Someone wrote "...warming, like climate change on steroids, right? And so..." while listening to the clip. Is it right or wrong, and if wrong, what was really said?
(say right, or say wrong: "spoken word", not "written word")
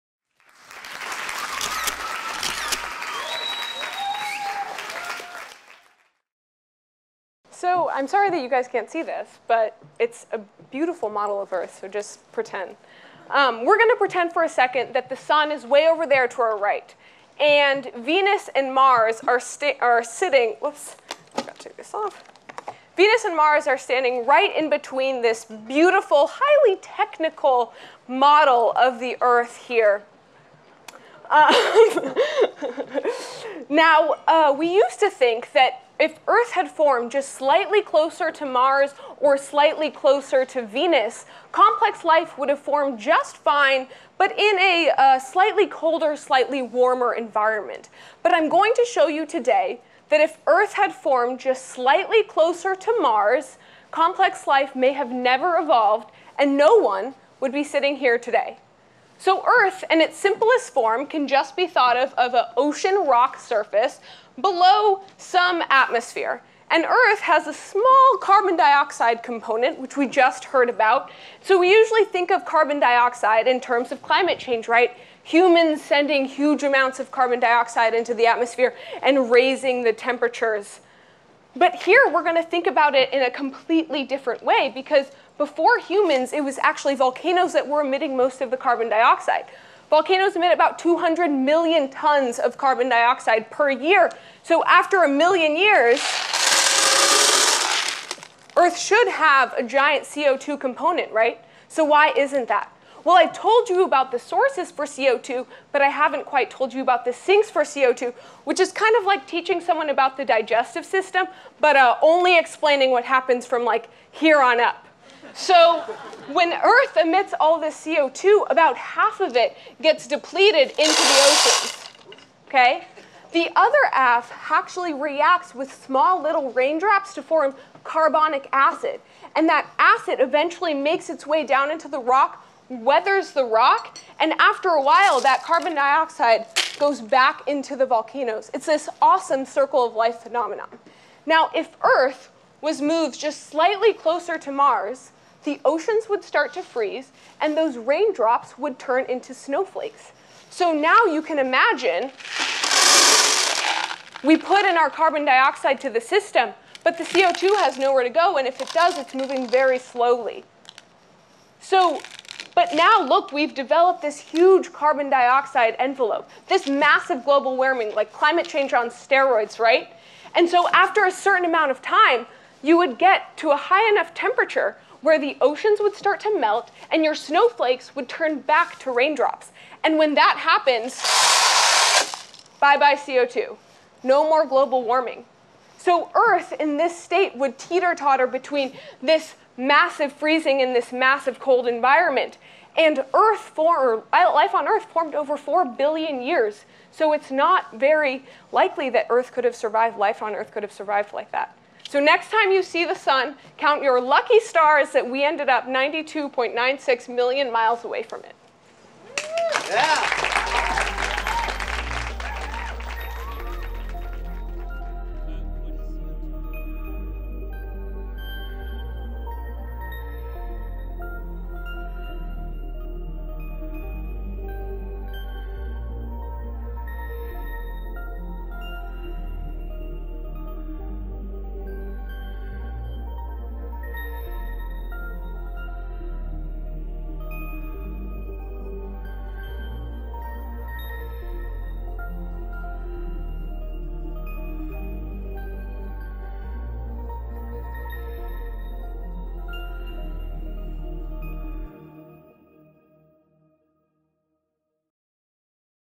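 right.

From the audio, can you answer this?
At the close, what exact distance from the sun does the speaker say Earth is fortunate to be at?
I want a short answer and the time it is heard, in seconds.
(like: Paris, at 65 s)
92.96 million miles, at 205 s.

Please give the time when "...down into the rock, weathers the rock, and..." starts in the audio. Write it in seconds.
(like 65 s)
131 s.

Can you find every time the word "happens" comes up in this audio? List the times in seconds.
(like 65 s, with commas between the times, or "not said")
113 s, 180 s.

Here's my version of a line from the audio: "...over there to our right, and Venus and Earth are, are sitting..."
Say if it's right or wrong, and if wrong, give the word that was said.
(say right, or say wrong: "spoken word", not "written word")
wrong: "Mars", not "Earth".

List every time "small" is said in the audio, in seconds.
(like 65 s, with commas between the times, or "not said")
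67 s, 125 s.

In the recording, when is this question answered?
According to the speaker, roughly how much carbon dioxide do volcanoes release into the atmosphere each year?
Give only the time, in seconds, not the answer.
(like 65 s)
90 s.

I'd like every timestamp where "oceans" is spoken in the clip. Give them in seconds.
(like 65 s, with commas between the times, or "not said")
62 s, 121 s, 145 s, 175 s.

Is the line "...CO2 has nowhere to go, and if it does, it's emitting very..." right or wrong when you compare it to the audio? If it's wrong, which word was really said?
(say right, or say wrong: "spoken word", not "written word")
wrong: "moving", not "emitting".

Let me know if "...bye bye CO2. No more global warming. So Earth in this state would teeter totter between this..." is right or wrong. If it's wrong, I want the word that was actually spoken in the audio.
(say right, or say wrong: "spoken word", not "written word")
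right.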